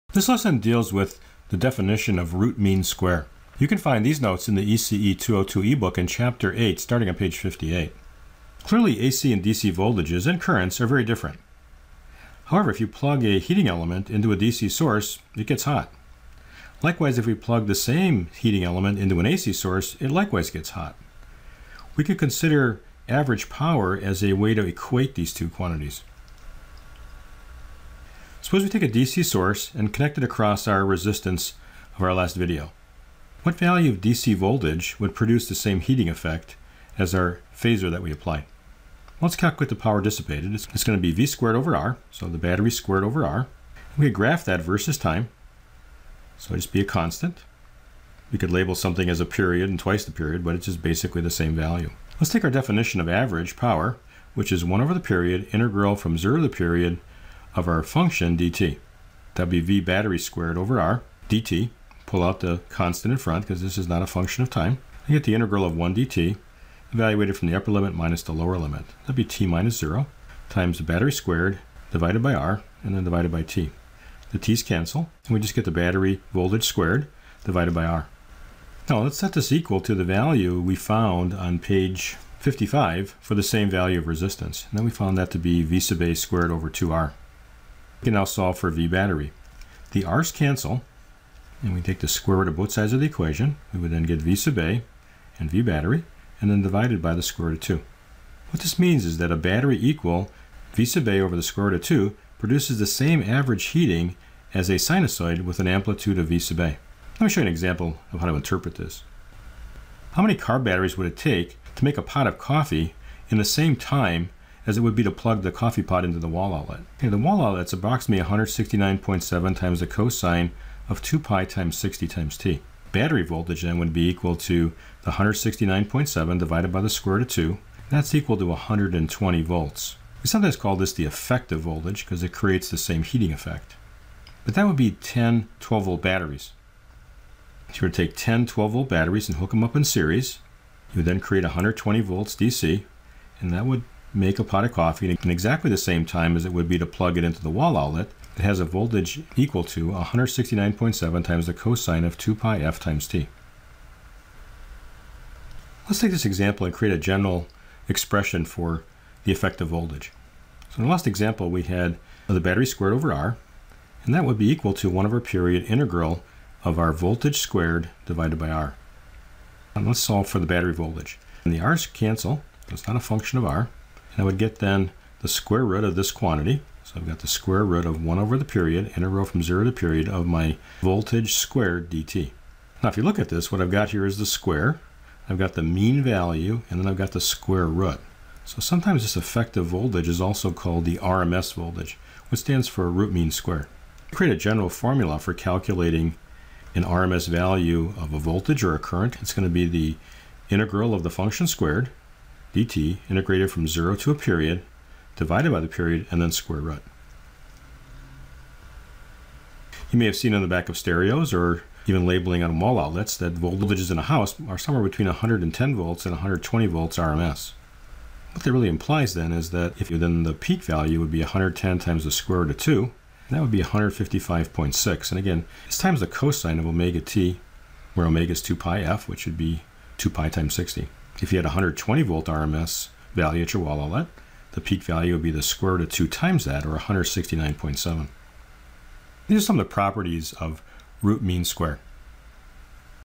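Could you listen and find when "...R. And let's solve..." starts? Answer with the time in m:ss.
2:48.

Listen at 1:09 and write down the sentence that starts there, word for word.
That'd be t minus 0 times the battery squared divided by R and then divided by t.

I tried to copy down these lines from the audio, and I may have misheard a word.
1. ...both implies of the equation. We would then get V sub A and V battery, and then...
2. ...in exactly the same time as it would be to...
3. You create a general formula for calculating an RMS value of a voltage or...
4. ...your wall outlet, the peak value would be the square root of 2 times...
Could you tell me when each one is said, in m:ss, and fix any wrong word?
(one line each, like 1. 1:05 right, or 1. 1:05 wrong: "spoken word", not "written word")
1. 1:32 wrong: "sides", not "implies"
2. 2:25 right
3. 3:14 right
4. 3:53 right.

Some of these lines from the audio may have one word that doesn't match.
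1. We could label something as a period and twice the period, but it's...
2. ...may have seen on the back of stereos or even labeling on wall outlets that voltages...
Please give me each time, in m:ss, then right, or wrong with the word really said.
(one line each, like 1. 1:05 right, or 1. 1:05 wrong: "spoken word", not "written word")
1. 0:48 right
2. 3:29 right.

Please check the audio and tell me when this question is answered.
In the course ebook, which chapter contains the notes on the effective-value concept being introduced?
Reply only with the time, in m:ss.
0:06.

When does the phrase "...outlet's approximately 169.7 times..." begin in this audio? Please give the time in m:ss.
1:57.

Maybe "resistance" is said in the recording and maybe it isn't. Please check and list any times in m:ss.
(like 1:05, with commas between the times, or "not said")
0:30, 1:24.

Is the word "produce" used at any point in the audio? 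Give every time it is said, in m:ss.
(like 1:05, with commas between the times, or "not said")
0:35, 1:42.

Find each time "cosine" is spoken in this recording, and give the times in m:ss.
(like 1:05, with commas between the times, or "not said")
1:59, 2:31, 3:46.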